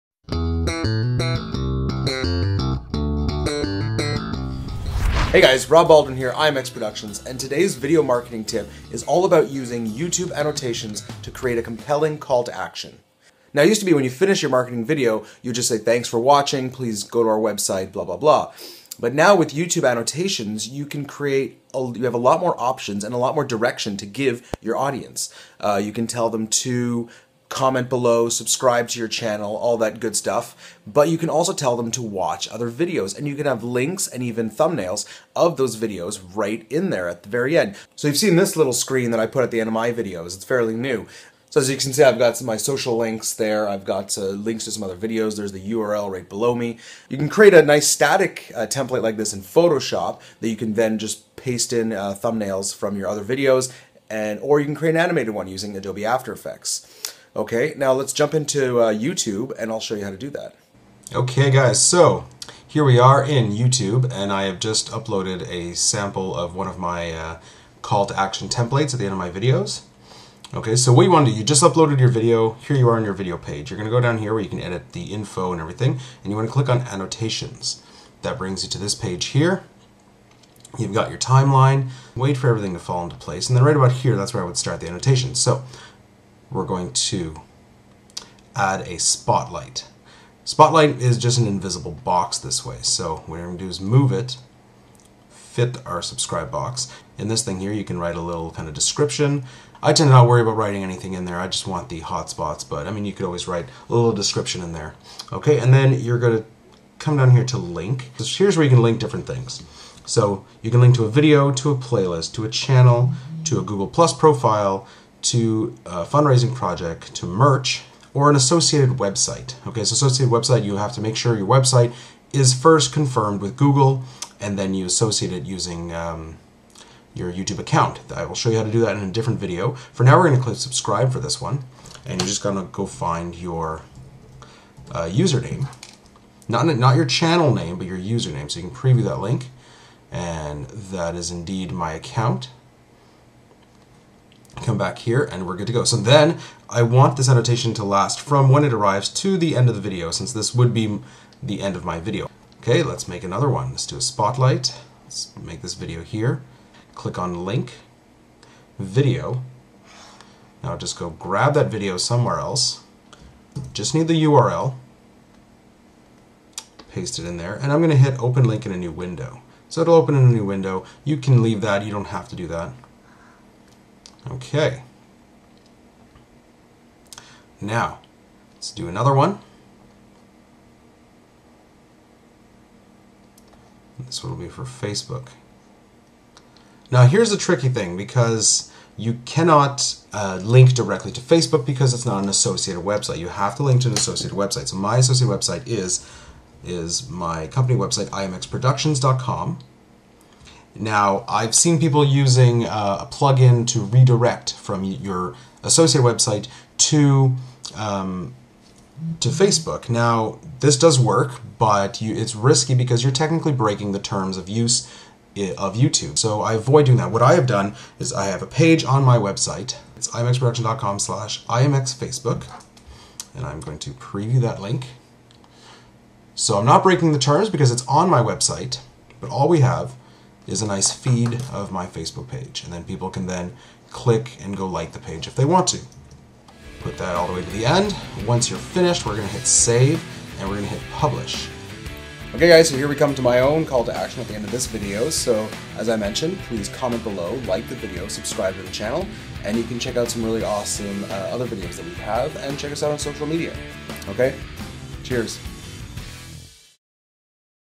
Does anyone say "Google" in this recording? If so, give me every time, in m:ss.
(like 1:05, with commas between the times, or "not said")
1:53, 2:03.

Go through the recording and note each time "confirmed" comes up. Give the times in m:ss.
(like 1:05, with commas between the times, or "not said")
2:02.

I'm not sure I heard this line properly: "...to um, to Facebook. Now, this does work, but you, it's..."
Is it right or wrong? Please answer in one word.
right.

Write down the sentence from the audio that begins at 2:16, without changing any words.
Not, not your channel name, but your username.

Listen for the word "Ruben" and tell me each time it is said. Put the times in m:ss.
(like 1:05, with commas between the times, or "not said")
not said.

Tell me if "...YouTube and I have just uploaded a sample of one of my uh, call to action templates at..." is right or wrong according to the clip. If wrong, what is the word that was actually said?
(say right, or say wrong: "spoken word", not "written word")
right.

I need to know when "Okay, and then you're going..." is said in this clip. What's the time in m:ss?
1:45.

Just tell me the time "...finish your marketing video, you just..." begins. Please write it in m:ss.
0:14.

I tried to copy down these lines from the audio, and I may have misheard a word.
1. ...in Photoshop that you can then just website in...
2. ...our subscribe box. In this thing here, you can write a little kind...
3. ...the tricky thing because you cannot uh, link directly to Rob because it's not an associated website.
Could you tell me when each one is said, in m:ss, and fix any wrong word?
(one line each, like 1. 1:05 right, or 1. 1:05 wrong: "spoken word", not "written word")
1. 0:49 wrong: "paste", not "website"
2. 1:35 right
3. 3:07 wrong: "Facebook", not "Rob".